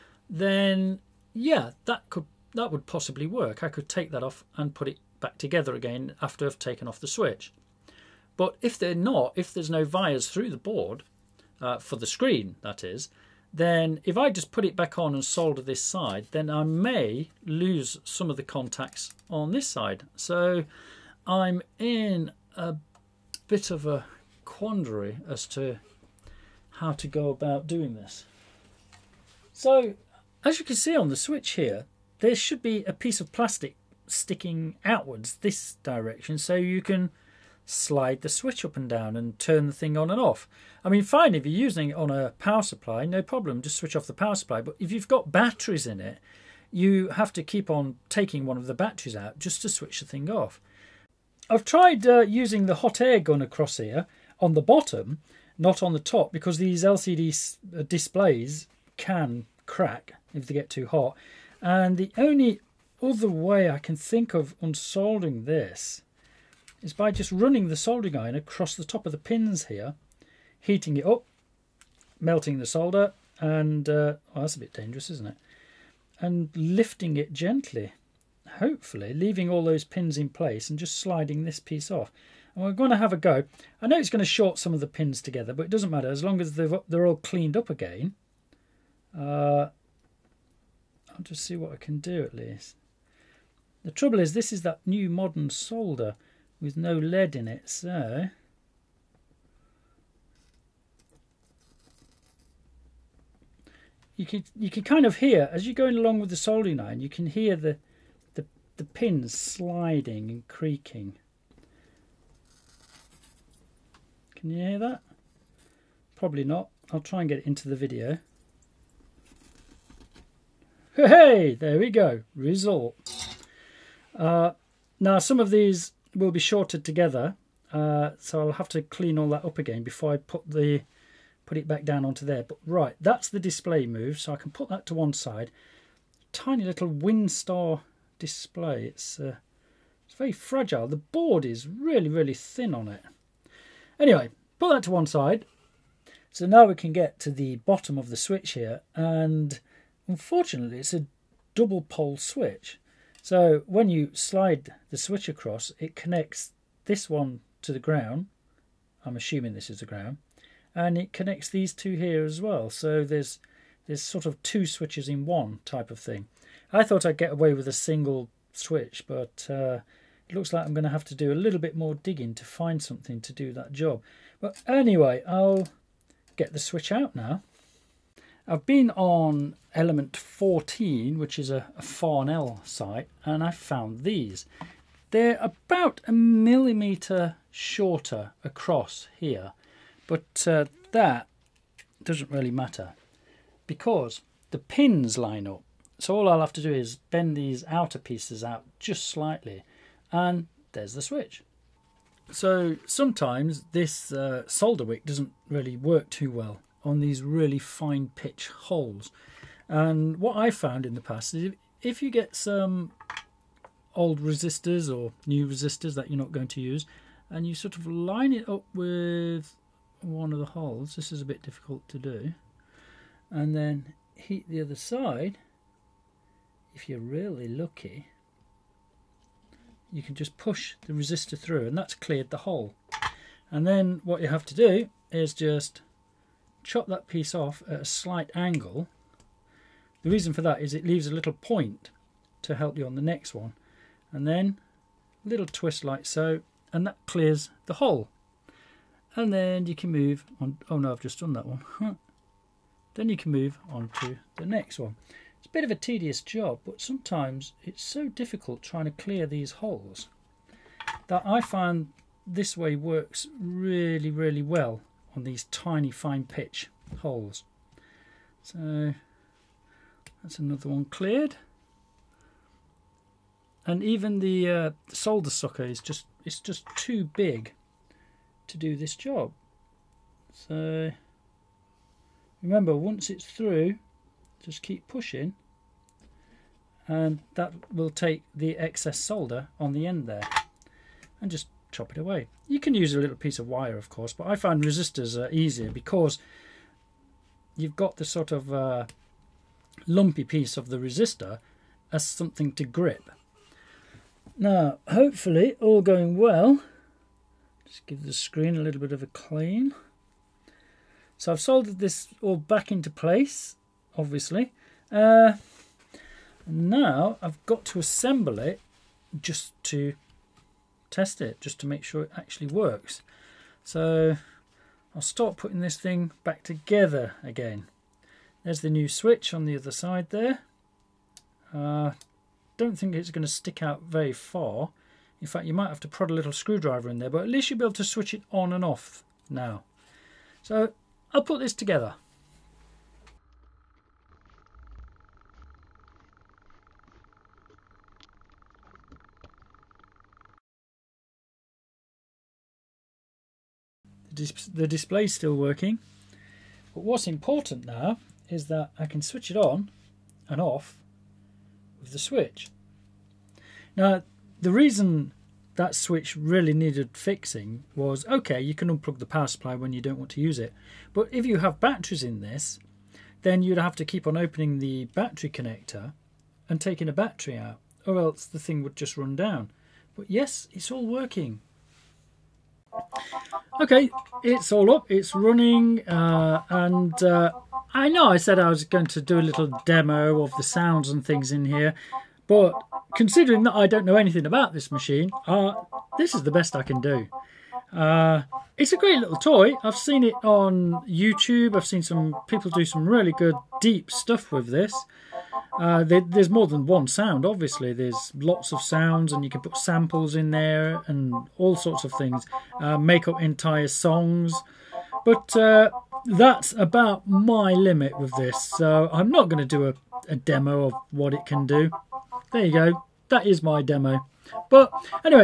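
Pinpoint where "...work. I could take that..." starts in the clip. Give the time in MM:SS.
00:03.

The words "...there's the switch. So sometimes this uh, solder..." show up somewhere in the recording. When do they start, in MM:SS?
03:20.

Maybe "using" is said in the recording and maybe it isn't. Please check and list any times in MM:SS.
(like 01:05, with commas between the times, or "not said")
00:41, 00:52.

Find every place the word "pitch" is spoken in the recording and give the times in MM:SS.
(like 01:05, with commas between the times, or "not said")
03:28, 04:26.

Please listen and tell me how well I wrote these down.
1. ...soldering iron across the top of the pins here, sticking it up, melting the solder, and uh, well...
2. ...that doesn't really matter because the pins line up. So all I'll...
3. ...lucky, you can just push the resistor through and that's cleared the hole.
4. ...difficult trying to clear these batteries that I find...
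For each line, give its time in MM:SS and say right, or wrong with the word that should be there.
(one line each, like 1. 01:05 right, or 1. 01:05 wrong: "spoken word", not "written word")
1. 01:07 wrong: "heating", not "sticking"
2. 03:10 right
3. 03:47 right
4. 04:18 wrong: "holes", not "batteries".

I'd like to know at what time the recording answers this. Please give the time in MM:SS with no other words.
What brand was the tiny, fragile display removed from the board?
02:16.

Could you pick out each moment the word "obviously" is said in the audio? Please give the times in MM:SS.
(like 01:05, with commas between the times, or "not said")
05:13, 06:47.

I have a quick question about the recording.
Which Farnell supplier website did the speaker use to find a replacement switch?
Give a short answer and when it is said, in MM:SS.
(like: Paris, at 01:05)
Element 14, at 02:59.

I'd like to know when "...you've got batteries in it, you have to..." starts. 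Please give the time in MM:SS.
00:44.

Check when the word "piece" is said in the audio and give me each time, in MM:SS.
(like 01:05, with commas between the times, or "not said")
00:32, 01:21, 03:17, 03:57, 04:53, 05:00.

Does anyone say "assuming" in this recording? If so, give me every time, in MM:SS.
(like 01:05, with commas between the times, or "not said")
02:39.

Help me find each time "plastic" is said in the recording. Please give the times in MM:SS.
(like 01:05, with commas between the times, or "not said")
00:33.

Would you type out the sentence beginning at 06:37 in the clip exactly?
Uh, it's a great little toy.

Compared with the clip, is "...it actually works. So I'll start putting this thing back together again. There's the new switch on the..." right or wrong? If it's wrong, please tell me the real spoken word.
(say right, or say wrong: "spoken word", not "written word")
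right.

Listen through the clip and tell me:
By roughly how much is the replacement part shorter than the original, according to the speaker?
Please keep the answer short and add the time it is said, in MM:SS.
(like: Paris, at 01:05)
1 millimetre, at 03:06.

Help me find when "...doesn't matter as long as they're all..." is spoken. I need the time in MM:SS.
01:25.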